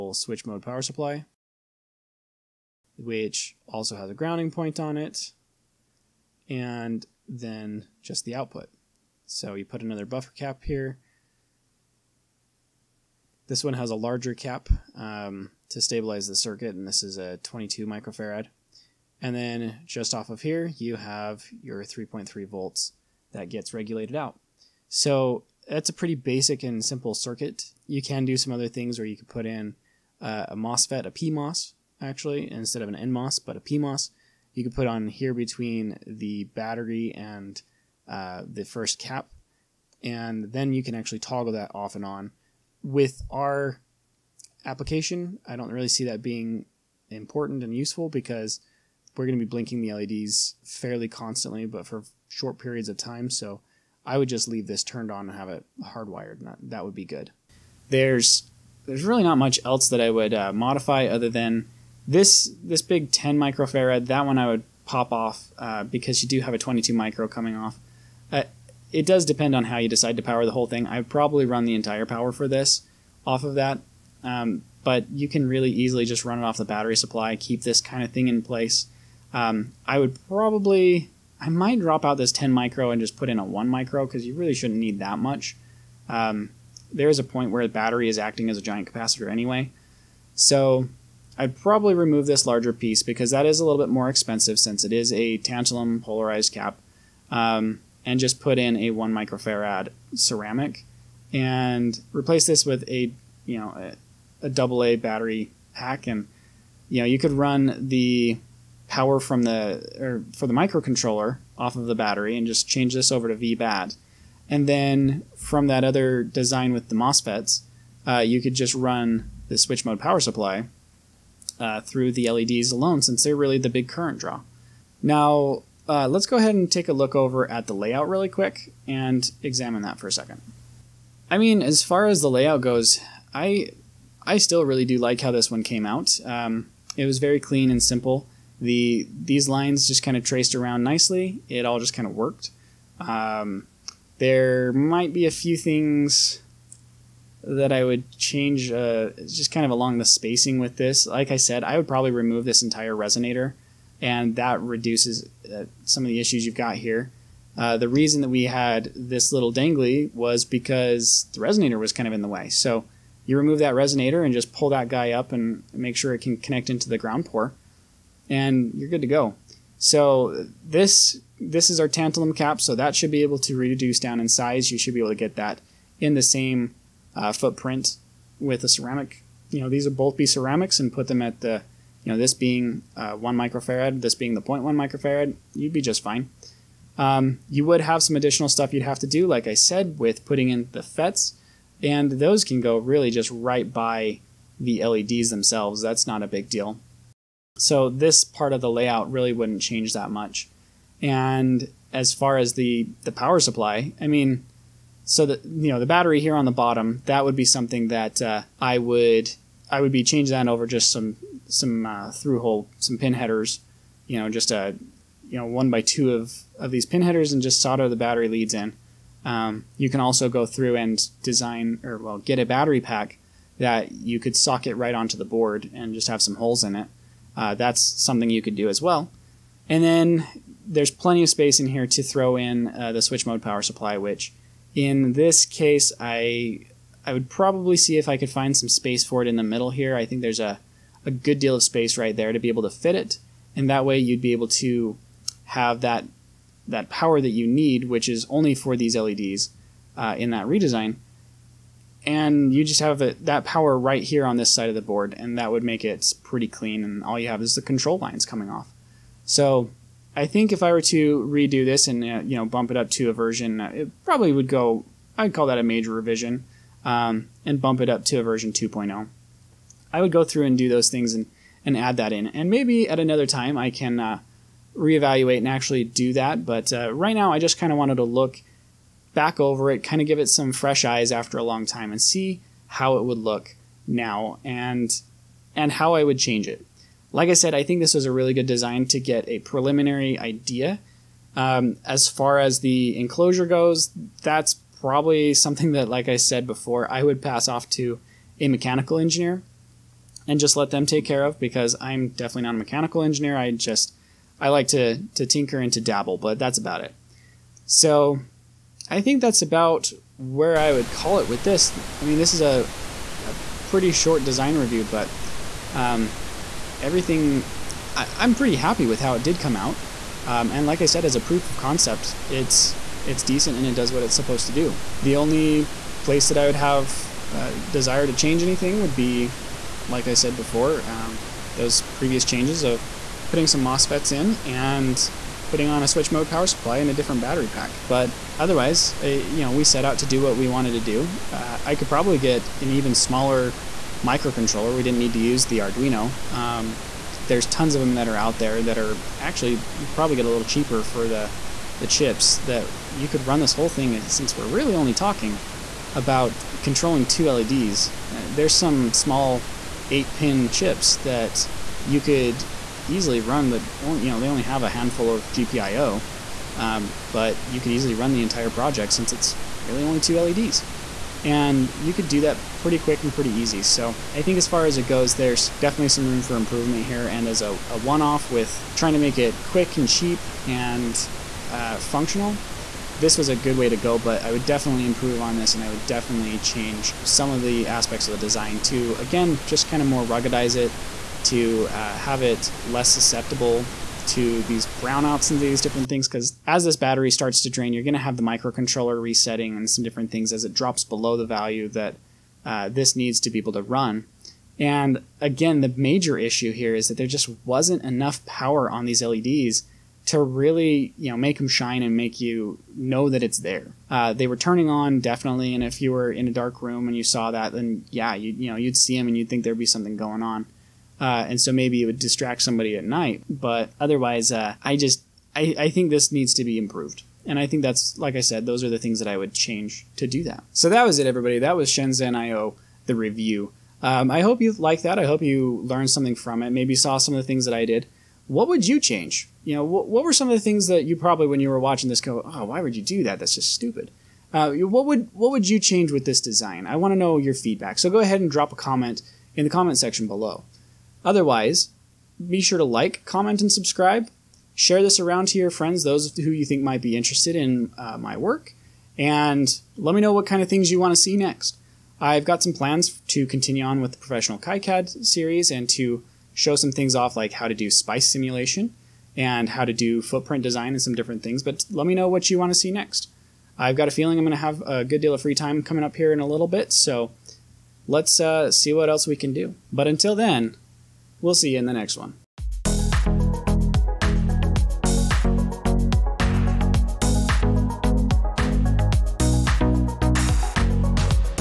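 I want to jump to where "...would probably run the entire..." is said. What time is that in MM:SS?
01:10.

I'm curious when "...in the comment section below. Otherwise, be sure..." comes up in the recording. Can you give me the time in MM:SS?
07:29.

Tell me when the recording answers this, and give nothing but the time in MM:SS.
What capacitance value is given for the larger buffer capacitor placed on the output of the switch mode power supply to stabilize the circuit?
00:17.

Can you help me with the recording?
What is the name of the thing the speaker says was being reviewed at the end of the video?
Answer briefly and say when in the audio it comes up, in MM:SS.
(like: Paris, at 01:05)
Shenzhen IO, at 07:11.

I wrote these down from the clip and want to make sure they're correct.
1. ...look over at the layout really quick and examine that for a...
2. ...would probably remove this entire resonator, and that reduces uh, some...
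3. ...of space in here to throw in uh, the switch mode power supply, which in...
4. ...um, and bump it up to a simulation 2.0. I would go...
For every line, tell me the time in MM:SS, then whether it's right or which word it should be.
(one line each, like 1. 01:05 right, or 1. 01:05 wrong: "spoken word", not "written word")
1. 02:06 right
2. 02:31 right
3. 03:51 right
4. 04:26 wrong: "version", not "simulation".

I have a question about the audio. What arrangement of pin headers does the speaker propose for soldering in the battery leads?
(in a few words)
1 by 2.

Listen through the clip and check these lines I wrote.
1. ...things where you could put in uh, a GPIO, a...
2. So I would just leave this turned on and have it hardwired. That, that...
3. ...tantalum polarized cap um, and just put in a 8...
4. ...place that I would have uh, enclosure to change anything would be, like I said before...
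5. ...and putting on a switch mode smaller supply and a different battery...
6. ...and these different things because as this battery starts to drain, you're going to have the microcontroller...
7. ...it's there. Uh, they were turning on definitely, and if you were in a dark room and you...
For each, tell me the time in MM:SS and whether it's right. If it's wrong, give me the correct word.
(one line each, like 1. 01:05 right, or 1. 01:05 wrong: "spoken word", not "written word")
1. 00:28 wrong: "MOSFET", not "GPIO"
2. 00:53 right
3. 01:35 wrong: "1", not "8"
4. 05:26 wrong: "desire", not "enclosure"
5. 05:34 wrong: "power", not "smaller"
6. 06:35 right
7. 06:53 right.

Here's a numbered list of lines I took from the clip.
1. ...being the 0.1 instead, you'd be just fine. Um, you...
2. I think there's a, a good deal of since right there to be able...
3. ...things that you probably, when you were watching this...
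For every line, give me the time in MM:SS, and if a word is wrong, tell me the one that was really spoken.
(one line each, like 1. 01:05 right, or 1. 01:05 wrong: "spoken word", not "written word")
1. 03:04 wrong: "microfarad", not "instead"
2. 03:59 wrong: "space", not "since"
3. 07:20 right.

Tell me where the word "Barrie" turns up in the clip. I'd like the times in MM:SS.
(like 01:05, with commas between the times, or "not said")
not said.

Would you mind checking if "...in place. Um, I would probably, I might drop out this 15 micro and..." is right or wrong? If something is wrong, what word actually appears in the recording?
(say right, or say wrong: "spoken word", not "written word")
wrong: "10", not "15".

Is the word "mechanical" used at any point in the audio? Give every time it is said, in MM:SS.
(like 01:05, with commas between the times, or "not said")
04:58, 05:02.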